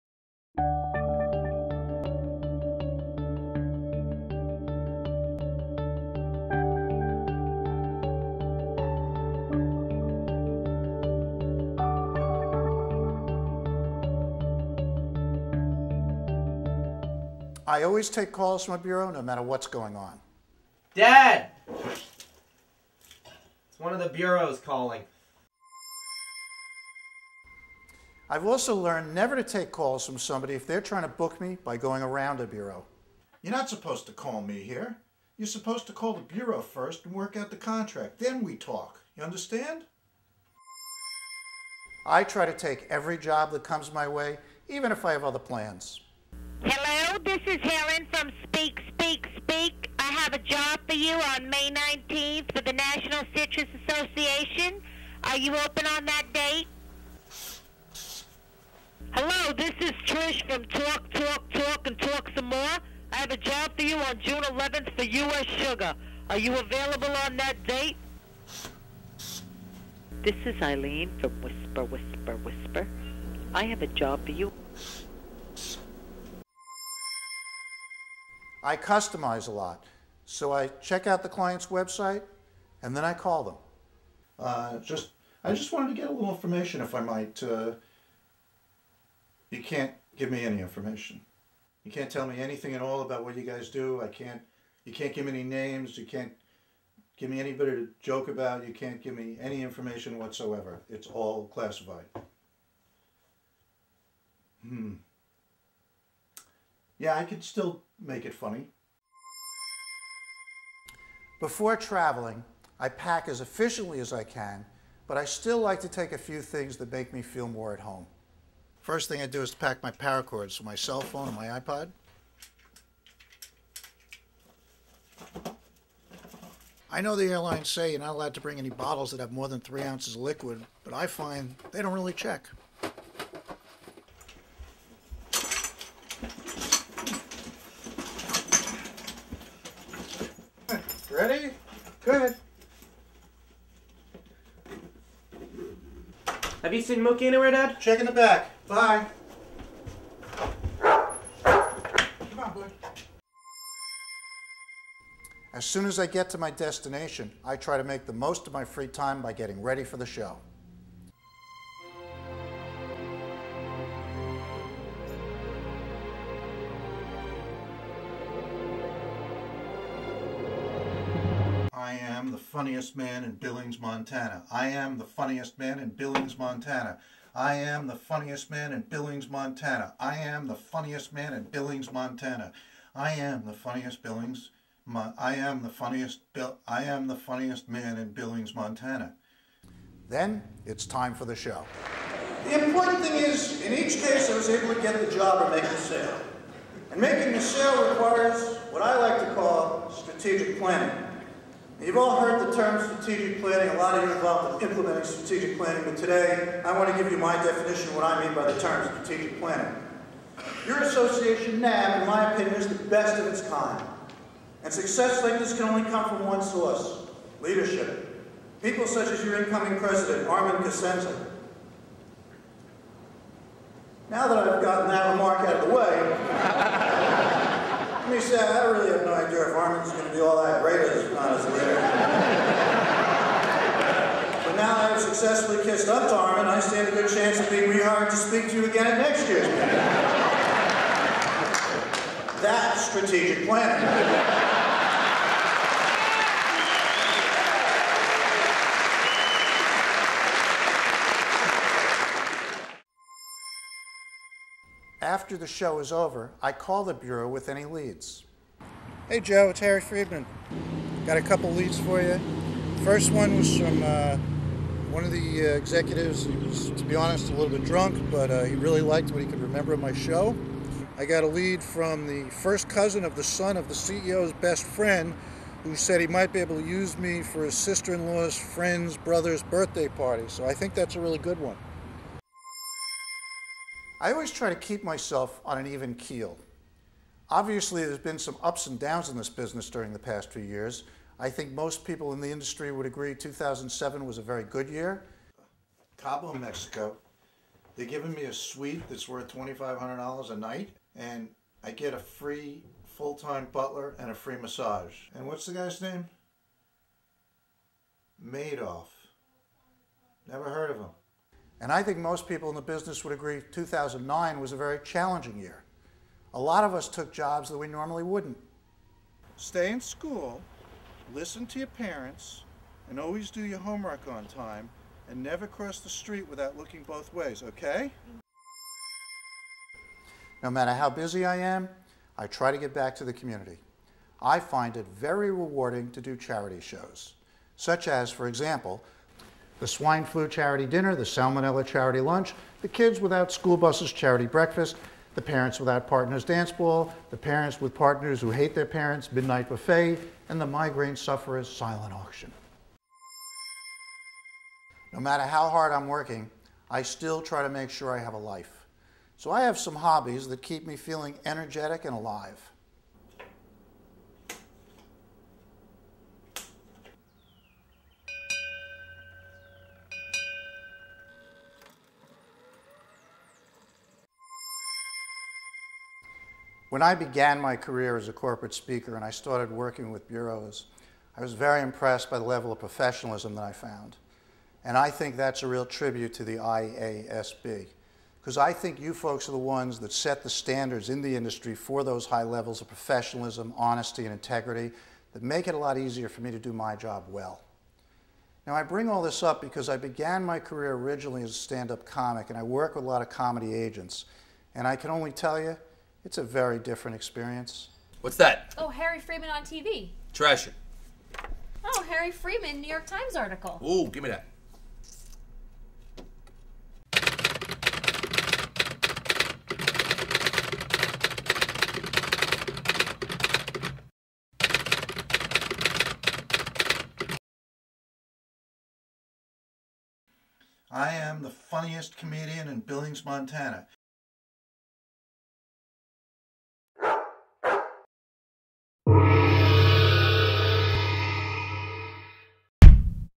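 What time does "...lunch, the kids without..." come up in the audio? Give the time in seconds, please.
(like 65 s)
342 s.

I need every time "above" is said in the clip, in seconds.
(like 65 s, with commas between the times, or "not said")
not said.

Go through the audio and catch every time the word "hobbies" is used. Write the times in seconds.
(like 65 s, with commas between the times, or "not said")
359 s.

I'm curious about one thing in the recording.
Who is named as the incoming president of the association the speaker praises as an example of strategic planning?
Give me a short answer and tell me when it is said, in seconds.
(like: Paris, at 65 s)
Armin Cosenza, at 220 s.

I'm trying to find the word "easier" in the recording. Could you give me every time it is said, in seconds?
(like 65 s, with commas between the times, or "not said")
395 s.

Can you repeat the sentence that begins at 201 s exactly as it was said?
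You've all heard the term strategic planning.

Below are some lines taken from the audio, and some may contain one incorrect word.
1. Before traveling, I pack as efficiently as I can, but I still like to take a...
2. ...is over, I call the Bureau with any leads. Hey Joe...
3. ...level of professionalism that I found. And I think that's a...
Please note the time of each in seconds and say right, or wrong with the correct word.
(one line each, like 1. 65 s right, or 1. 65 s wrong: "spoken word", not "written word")
1. 111 s right
2. 255 s right
3. 382 s right.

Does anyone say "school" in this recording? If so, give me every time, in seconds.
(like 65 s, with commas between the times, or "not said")
319 s, 343 s.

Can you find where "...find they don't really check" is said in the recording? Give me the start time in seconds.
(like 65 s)
131 s.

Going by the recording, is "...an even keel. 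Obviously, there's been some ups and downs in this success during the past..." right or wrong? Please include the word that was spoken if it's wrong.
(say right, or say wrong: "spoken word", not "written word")
wrong: "business", not "success".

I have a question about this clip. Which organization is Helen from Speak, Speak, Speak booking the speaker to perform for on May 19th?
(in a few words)
National Citrus Association.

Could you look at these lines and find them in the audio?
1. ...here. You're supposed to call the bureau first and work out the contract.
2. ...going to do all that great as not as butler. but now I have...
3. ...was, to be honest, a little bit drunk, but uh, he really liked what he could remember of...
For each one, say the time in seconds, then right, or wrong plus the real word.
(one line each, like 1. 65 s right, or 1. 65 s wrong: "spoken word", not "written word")
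1. 34 s right
2. 229 s wrong: "leader", not "butler"
3. 266 s right.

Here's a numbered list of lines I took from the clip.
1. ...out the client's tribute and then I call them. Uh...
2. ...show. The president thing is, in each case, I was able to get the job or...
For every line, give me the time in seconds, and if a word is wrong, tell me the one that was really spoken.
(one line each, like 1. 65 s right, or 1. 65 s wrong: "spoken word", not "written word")
1. 81 s wrong: "website", not "tribute"
2. 191 s wrong: "important", not "president".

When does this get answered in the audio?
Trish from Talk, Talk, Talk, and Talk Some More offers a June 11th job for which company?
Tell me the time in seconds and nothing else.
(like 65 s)
65 s.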